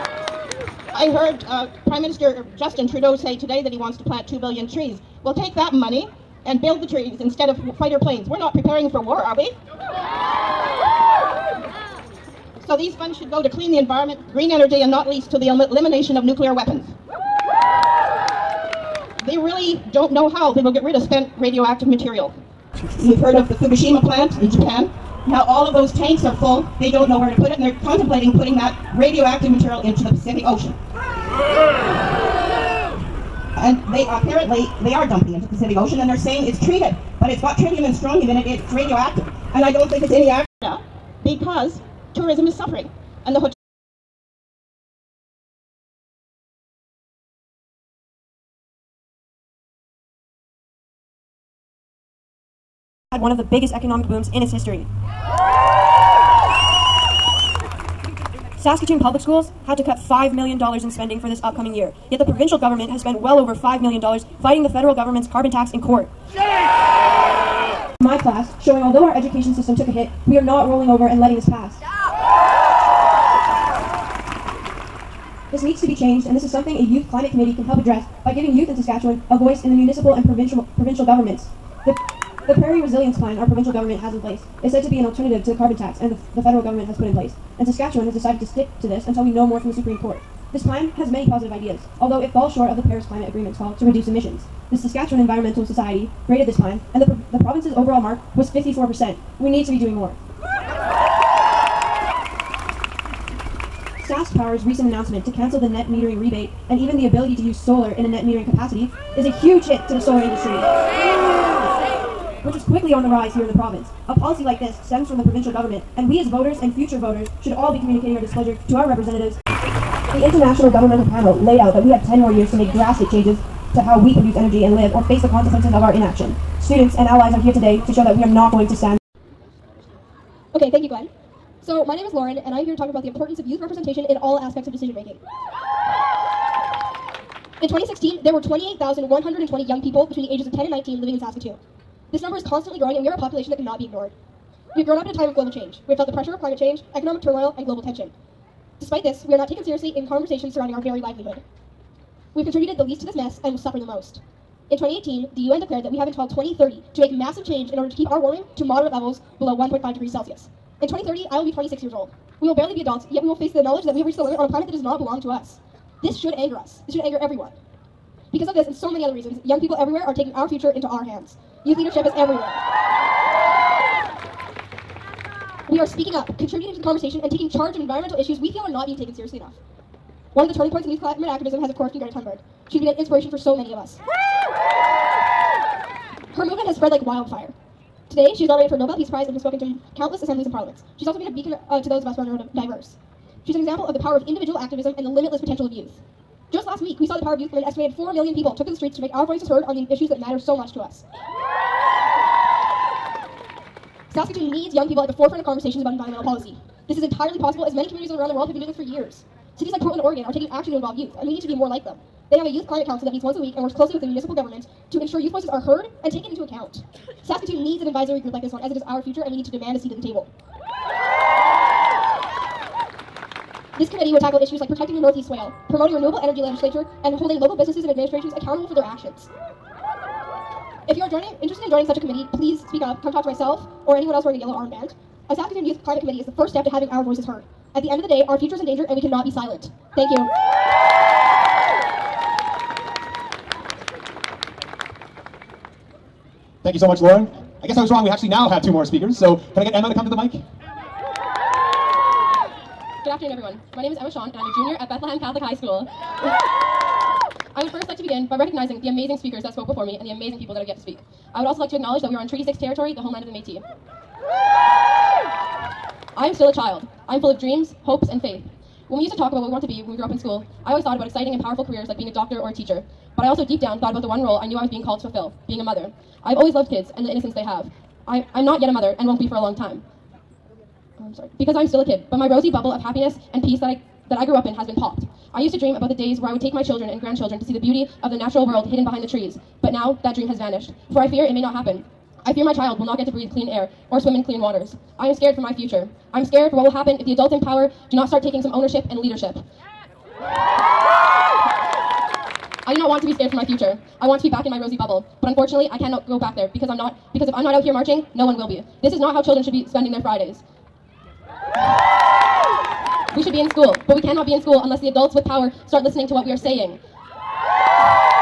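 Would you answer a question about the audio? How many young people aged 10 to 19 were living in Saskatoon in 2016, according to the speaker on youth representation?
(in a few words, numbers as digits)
28,120.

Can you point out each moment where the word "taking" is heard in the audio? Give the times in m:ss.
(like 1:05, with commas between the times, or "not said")
2:50, 2:57, 3:30, 4:58.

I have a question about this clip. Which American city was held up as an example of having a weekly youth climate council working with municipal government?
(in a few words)
Portland, Oregon.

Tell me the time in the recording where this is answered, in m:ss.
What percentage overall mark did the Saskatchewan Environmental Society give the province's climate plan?
1:38.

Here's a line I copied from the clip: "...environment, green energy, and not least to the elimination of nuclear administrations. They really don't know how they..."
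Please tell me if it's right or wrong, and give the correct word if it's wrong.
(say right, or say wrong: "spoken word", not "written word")
wrong: "weapons", not "administrations".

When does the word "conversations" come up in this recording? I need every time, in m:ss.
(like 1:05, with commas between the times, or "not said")
2:30, 2:56, 3:25.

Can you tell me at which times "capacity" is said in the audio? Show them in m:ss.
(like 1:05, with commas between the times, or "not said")
1:48.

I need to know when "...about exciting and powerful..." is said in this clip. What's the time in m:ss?
4:30.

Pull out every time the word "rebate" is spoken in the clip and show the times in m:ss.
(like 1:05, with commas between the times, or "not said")
1:46.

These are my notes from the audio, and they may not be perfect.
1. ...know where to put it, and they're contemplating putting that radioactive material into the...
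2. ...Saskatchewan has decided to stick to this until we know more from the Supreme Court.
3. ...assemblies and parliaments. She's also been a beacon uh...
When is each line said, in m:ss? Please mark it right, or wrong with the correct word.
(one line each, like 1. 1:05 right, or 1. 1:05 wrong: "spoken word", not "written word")
1. 0:27 right
2. 1:27 right
3. 3:10 right.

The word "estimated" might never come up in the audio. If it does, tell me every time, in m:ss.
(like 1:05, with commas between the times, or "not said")
3:17.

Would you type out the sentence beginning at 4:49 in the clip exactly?
But now that dream has vanished, for I fear it may not happen.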